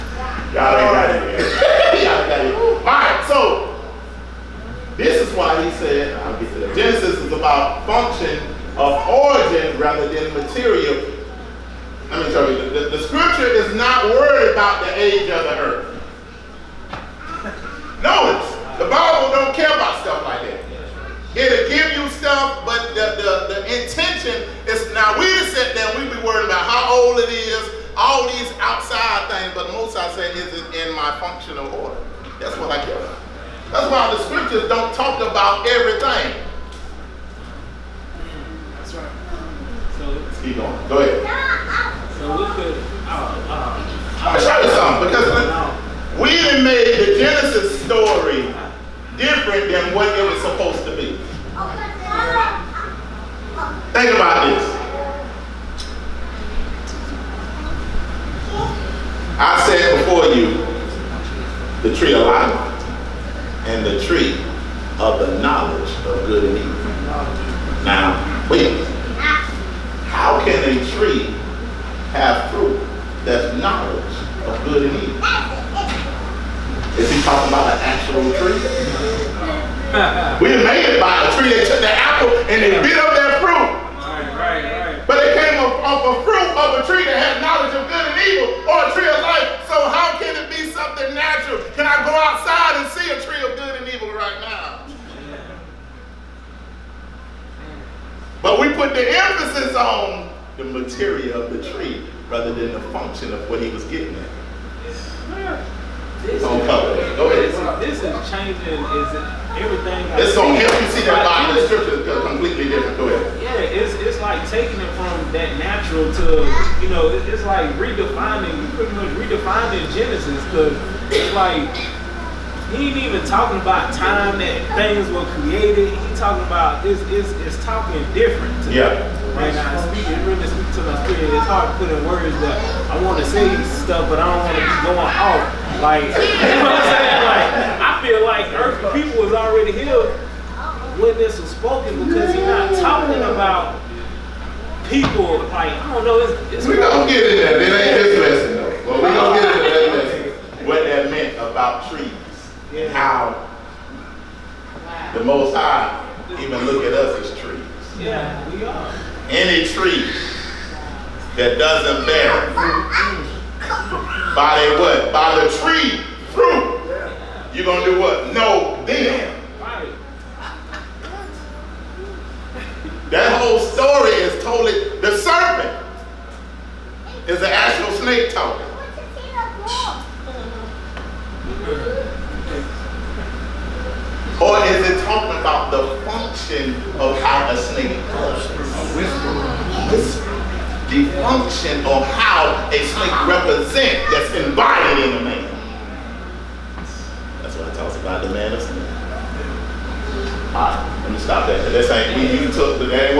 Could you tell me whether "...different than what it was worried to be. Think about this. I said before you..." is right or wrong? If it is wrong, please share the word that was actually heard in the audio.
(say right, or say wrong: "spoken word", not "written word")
wrong: "supposed", not "worried".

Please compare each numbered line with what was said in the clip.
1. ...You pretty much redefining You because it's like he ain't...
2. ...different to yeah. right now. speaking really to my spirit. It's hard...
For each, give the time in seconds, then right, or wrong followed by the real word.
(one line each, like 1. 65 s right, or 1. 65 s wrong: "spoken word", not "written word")
1. 118 s wrong: "Genesis", not "You"
2. 128 s right.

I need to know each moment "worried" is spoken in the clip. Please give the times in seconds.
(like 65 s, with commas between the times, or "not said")
14 s, 26 s.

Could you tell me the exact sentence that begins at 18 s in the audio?
Notice, the Bible don't care about stuff like that.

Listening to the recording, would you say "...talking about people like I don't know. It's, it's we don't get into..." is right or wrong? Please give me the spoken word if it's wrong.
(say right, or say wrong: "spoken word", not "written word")
right.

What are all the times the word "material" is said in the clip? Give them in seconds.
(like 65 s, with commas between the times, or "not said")
10 s, 100 s.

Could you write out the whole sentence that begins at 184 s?
Or is it talking about the function of how a snake goes a whisper?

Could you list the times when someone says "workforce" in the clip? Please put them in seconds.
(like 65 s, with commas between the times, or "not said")
not said.